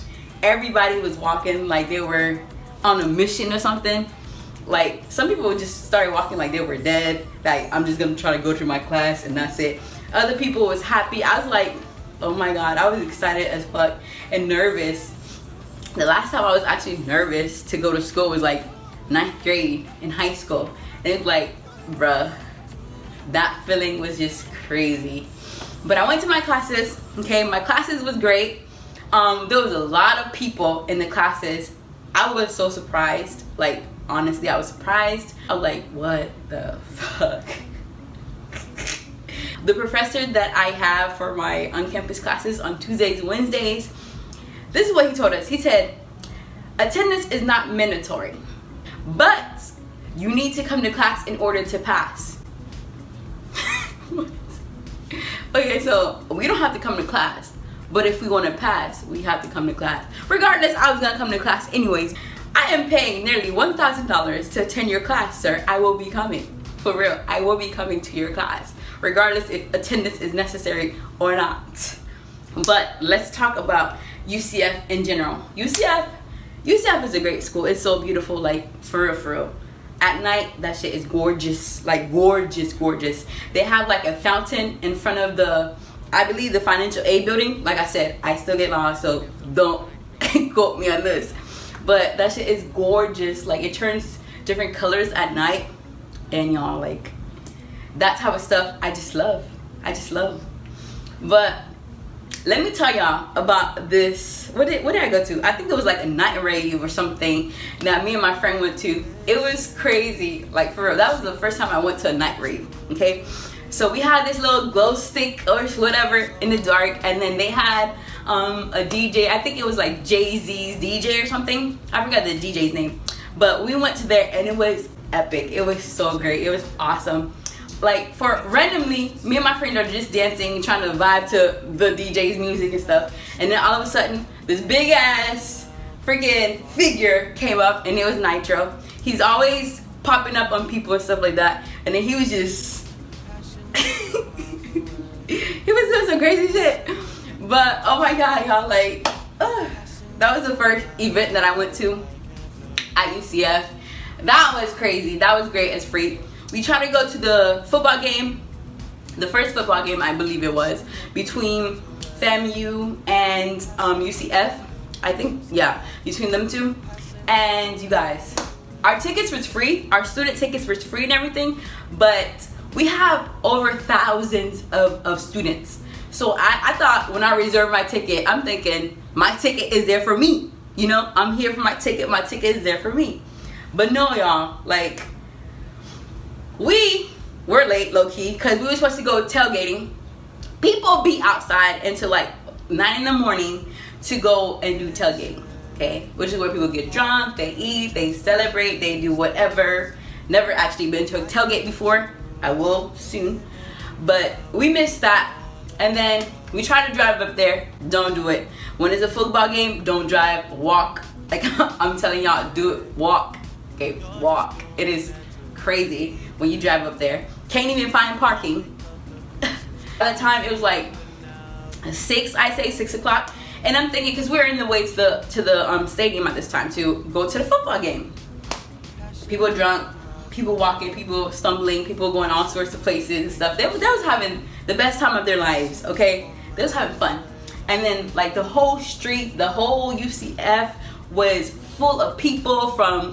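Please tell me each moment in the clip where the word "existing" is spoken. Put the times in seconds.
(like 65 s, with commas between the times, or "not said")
not said.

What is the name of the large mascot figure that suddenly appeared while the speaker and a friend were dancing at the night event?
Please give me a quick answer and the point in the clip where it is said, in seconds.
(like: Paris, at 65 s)
Knightro, at 138 s.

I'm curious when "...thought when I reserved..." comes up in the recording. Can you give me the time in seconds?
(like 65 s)
176 s.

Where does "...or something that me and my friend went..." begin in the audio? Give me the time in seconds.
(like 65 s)
106 s.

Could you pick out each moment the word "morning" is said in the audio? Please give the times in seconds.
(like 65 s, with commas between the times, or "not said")
193 s.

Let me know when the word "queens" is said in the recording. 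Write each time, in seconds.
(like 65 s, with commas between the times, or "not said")
not said.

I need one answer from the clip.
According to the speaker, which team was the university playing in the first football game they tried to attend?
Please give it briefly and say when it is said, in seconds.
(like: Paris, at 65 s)
FAMU, at 162 s.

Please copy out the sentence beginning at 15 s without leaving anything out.
The last time I was actually nervous to go to school was like ninth grade in high school.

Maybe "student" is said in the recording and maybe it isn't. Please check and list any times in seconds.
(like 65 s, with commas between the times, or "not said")
170 s, 175 s.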